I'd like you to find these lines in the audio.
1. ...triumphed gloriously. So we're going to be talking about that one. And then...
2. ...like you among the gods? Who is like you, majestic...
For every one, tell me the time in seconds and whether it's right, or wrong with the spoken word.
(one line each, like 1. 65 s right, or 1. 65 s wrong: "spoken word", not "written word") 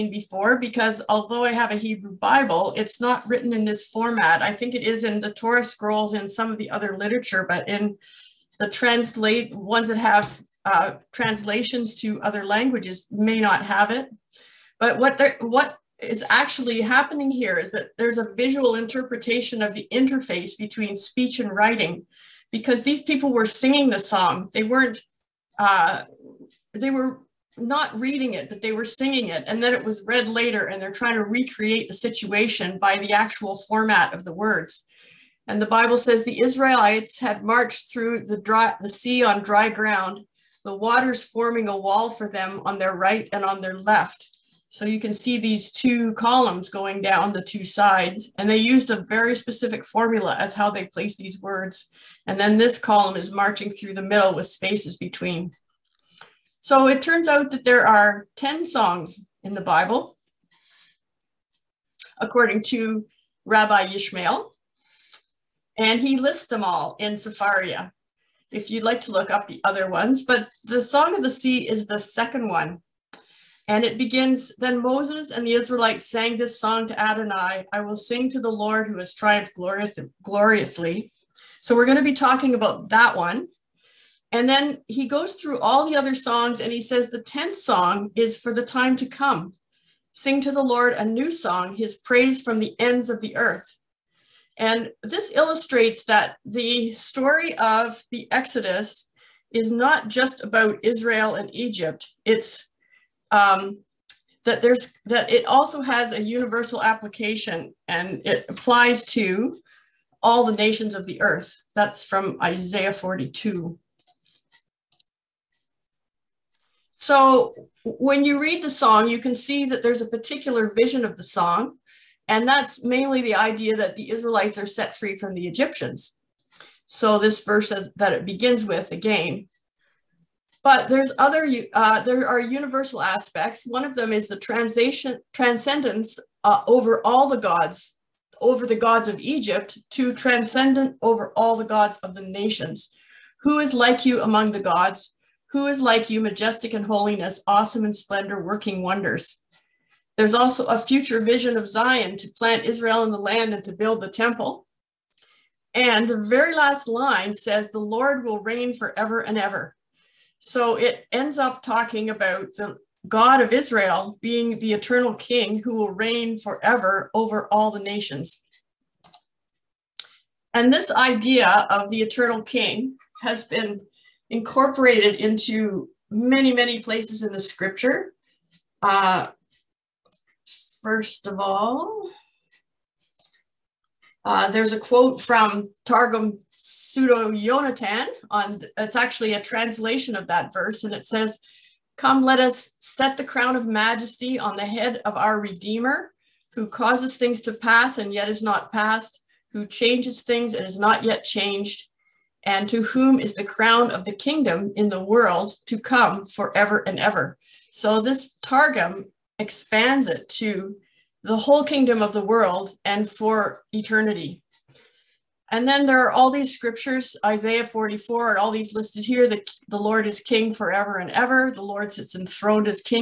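1. 79 s right
2. 143 s right.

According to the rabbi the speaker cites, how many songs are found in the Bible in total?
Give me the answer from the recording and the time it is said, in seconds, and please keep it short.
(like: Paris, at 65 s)
10, at 58 s.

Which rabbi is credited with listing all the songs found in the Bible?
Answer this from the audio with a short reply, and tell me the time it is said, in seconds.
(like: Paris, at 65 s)
Rabbi Yishmael, at 63 s.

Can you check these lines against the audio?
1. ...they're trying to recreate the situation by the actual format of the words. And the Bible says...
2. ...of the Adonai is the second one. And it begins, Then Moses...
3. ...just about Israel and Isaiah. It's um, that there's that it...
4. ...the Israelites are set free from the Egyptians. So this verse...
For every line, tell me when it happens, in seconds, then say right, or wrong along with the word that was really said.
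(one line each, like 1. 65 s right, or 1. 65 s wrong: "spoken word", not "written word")
1. 30 s right
2. 71 s wrong: "Sea", not "Adonai"
3. 100 s wrong: "Egypt", not "Isaiah"
4. 123 s right.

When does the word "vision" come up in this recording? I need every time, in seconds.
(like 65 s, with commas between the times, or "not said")
120 s, 151 s.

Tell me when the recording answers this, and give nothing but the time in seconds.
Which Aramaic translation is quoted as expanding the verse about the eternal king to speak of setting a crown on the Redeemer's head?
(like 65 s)
185 s.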